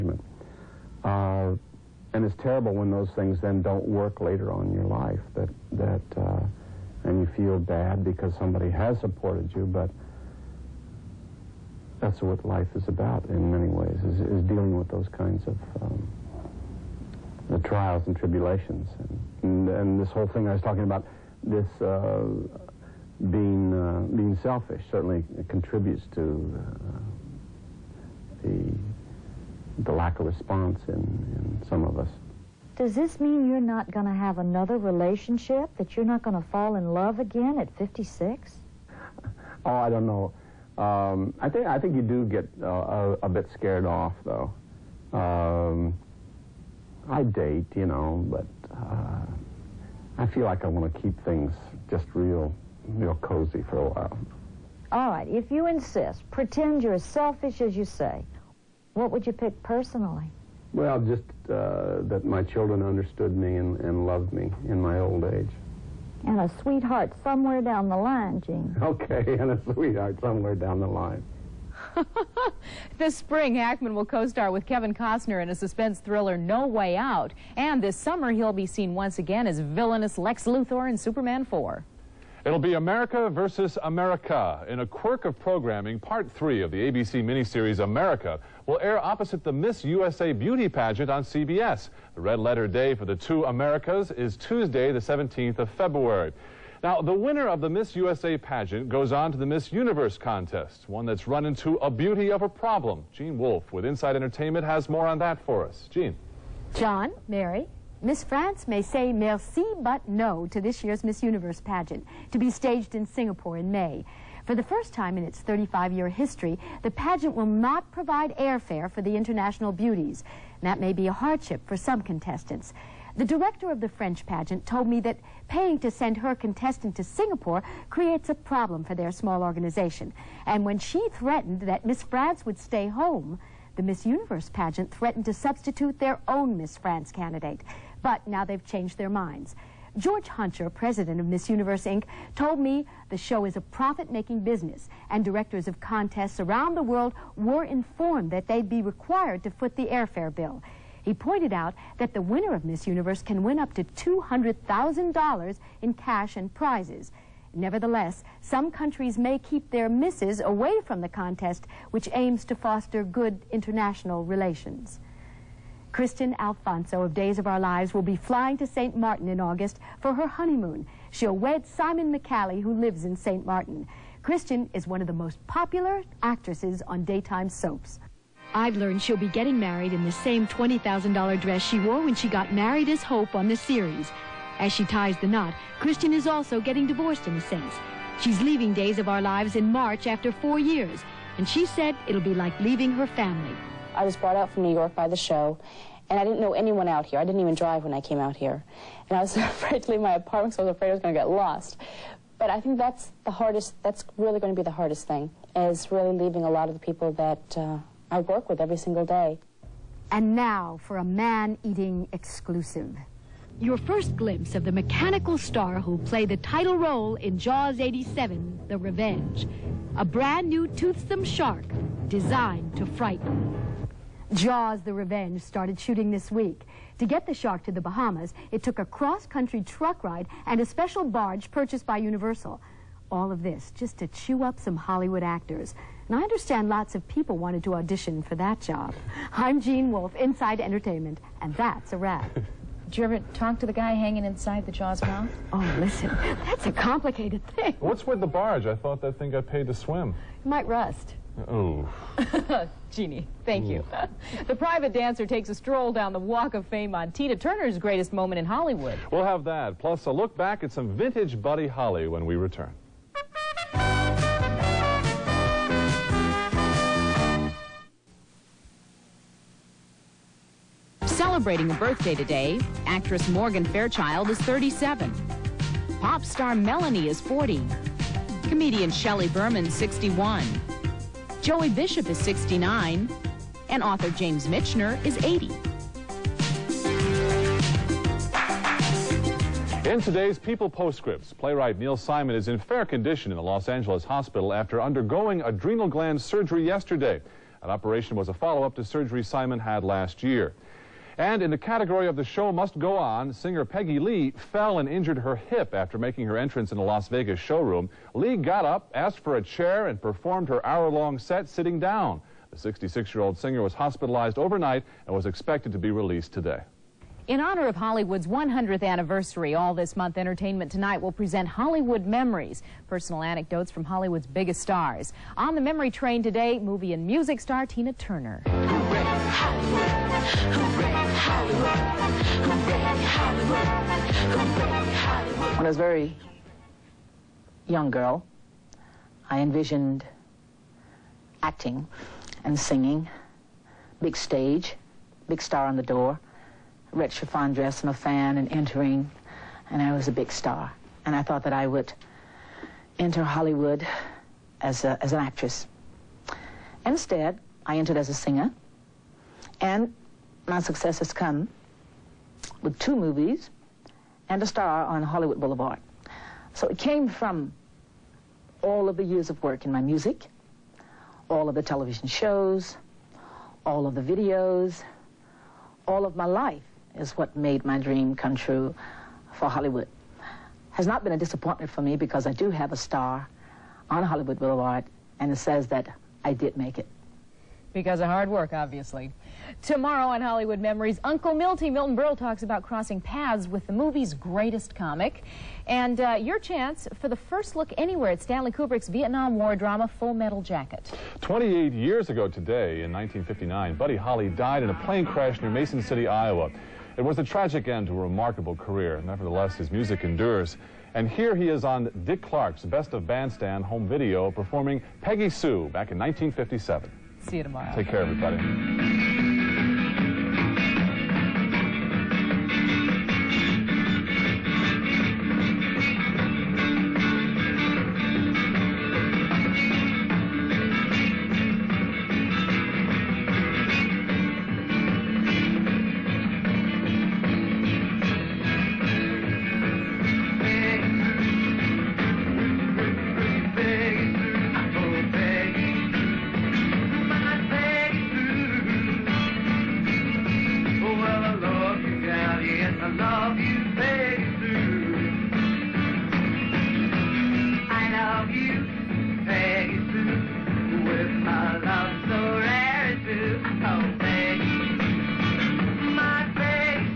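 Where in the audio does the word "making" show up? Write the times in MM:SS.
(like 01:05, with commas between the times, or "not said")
02:23, 05:05.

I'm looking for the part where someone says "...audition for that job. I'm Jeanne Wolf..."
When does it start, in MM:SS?
03:57.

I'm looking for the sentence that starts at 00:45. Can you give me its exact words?
Um, I date, you know, but uh, I feel like I want to keep things just real, real cozy for a while.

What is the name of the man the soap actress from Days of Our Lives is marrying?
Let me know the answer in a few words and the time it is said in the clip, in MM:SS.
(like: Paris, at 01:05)
Simon McCallie, at 02:51.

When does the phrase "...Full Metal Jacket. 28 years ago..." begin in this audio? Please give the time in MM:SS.
06:39.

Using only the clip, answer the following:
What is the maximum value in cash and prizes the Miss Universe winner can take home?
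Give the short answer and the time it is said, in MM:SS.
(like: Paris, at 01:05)
$200,000, at 02:33.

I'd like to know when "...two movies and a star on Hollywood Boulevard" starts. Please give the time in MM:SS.
06:02.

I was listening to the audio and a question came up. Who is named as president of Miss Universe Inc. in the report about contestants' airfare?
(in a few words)
George Hunter.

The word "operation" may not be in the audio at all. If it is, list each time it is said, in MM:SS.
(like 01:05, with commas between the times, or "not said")
04:57.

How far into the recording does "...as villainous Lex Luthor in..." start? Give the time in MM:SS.
01:19.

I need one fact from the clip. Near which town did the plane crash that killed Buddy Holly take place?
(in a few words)
Mason City, Iowa.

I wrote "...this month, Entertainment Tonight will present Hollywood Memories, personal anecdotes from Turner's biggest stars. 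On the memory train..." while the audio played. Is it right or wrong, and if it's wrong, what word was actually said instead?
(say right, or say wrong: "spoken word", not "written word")
wrong: "Hollywood", not "Turner".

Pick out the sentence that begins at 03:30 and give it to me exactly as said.
And now for a man-eating exclusive.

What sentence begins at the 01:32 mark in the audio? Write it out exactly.
The red letter day for the two Americas is Tuesday, the 17th of February.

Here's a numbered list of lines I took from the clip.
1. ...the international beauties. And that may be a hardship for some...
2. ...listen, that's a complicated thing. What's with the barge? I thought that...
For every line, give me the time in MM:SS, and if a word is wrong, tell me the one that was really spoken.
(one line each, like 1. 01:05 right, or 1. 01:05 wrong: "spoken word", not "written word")
1. 01:59 right
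2. 04:05 right.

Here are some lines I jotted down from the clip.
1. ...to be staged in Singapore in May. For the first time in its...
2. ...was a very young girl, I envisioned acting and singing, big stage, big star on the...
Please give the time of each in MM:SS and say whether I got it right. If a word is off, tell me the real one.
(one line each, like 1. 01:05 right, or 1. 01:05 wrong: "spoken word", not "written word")
1. 01:52 right
2. 05:35 right.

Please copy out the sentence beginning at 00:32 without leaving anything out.
Does this mean you're not going to have another relationship?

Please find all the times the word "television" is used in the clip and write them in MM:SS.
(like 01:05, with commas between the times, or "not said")
06:11.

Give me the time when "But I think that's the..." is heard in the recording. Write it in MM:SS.
03:22.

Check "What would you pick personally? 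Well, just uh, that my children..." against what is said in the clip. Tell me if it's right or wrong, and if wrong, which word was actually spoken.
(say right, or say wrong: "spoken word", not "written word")
right.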